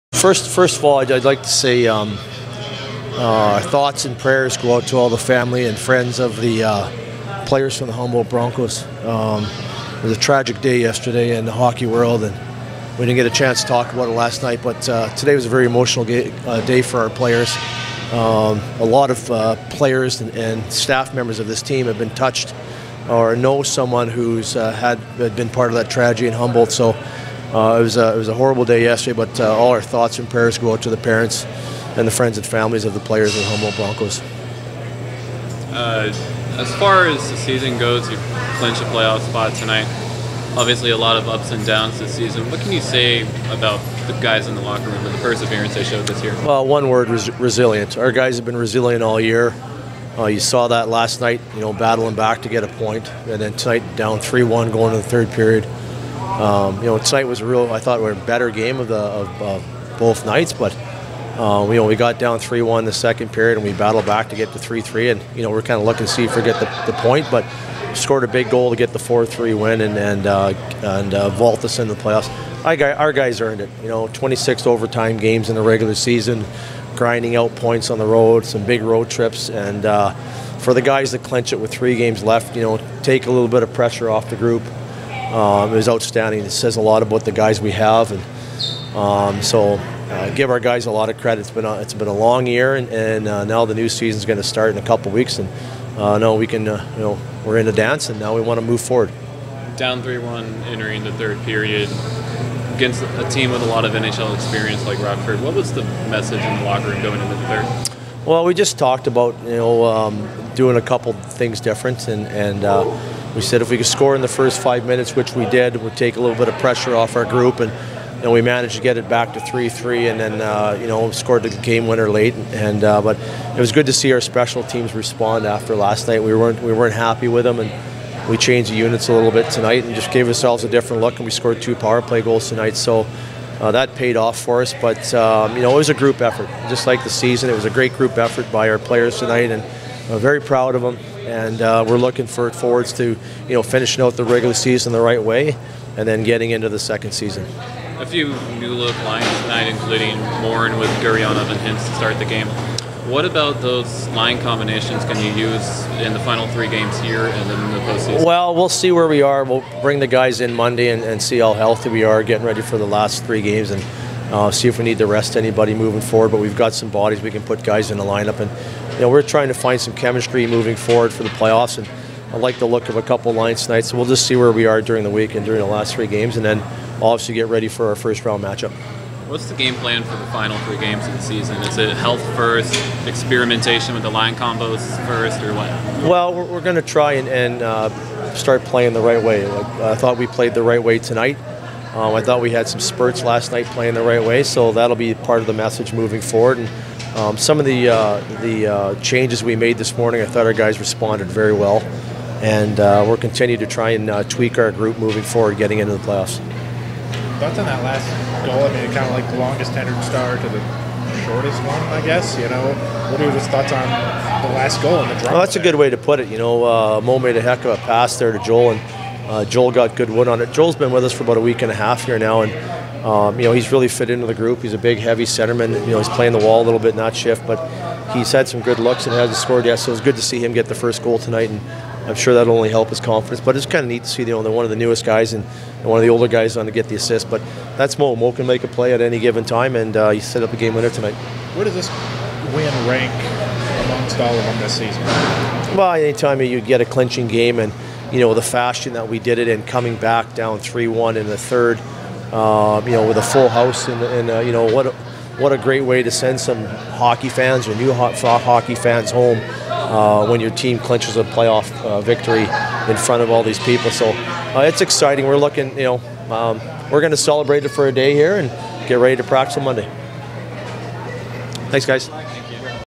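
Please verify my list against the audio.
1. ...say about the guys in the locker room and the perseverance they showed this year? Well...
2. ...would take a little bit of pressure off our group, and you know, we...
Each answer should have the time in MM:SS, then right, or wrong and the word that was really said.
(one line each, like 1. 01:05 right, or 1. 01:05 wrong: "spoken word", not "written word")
1. 00:42 right
2. 01:55 right.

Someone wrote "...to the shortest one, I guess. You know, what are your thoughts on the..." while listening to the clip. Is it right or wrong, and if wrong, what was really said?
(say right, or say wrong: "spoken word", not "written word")
right.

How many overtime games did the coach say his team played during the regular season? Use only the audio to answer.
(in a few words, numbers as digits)
26.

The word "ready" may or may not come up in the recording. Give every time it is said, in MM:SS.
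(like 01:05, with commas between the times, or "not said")
02:42, 02:57, 04:28.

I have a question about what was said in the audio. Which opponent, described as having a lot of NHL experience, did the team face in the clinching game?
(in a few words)
Rockford.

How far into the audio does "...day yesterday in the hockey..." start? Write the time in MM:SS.
00:10.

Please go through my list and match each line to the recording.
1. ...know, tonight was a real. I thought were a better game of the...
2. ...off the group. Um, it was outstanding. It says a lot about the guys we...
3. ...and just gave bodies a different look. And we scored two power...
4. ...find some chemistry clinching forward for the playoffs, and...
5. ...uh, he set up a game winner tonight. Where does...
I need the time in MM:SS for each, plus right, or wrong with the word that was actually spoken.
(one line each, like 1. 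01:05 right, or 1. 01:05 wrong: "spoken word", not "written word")
1. 00:56 right
2. 01:24 right
3. 02:09 wrong: "ourselves", not "bodies"
4. 02:49 wrong: "moving", not "clinching"
5. 03:59 right.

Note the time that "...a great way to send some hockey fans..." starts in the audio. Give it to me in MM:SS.
04:15.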